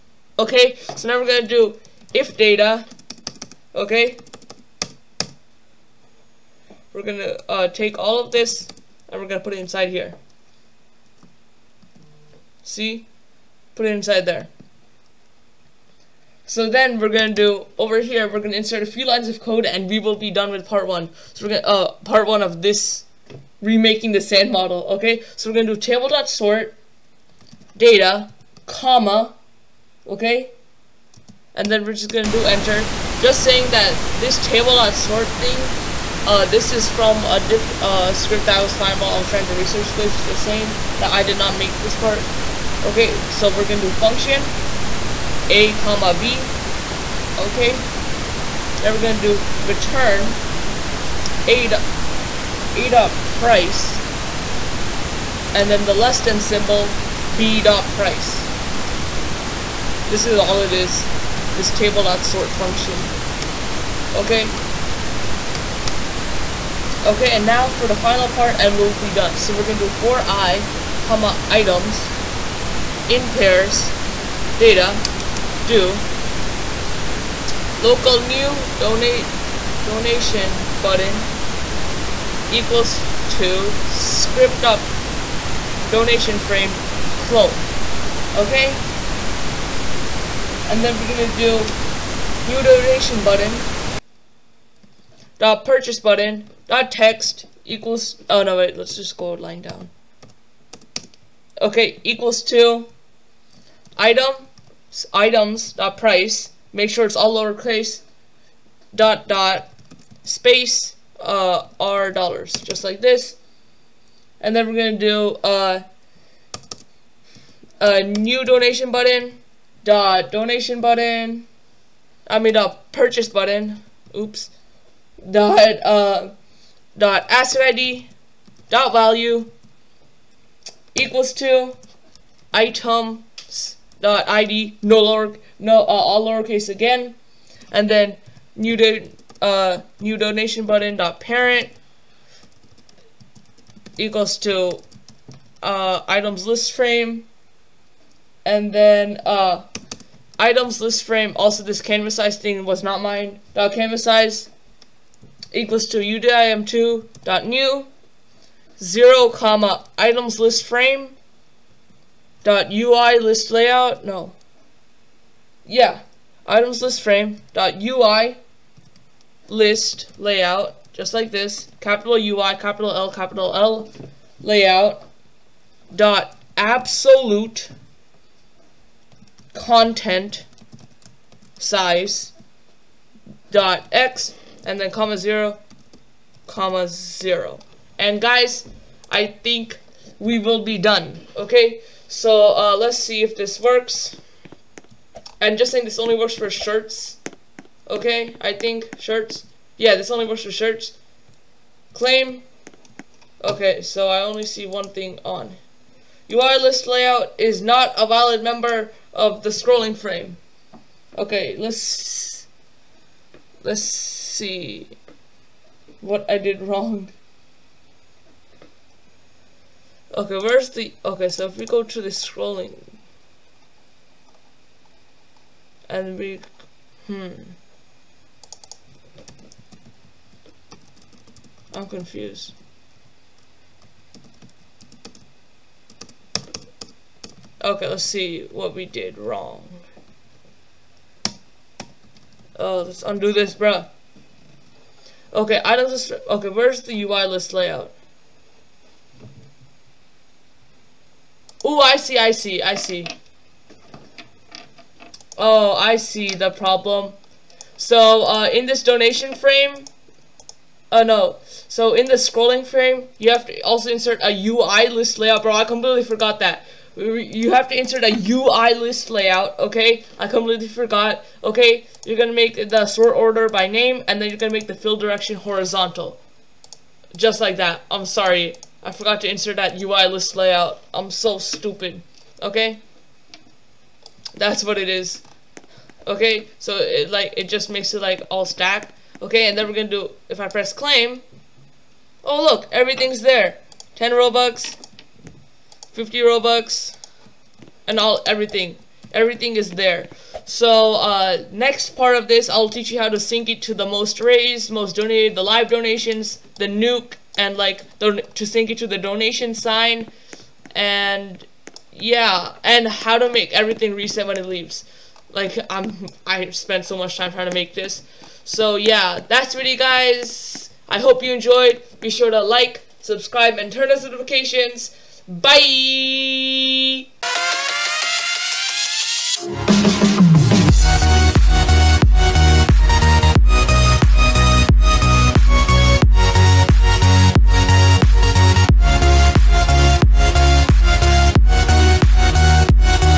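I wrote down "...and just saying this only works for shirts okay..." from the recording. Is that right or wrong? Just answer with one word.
right.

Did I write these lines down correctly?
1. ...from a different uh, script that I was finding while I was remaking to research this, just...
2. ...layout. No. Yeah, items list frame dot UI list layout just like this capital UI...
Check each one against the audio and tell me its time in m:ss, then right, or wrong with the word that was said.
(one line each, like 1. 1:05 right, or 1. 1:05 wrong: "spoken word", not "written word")
1. 0:36 wrong: "trying", not "remaking"
2. 2:43 right.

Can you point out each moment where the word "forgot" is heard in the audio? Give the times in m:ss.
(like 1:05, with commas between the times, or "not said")
4:26, 4:30, 4:38.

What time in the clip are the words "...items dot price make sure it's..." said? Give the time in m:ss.
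1:45.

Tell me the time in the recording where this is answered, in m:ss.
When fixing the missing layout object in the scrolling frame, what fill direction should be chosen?
4:35.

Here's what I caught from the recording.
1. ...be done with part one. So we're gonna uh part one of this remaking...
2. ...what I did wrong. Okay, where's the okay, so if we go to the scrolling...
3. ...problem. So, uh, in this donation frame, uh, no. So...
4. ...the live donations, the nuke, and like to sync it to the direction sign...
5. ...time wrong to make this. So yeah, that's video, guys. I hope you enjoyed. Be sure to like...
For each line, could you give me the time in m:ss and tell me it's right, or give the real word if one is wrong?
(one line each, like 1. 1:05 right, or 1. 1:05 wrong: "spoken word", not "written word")
1. 0:20 right
2. 3:36 right
3. 4:16 right
4. 5:05 wrong: "donation", not "direction"
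5. 5:17 wrong: "trying", not "wrong".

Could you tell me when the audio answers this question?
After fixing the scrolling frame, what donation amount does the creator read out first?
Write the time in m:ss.
4:53.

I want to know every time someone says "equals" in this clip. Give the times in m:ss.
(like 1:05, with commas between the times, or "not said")
1:22, 1:37, 1:42, 2:10, 2:23, 2:35.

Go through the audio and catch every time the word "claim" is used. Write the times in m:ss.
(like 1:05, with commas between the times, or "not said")
3:21, 4:50.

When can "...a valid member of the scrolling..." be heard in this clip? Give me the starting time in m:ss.
3:27.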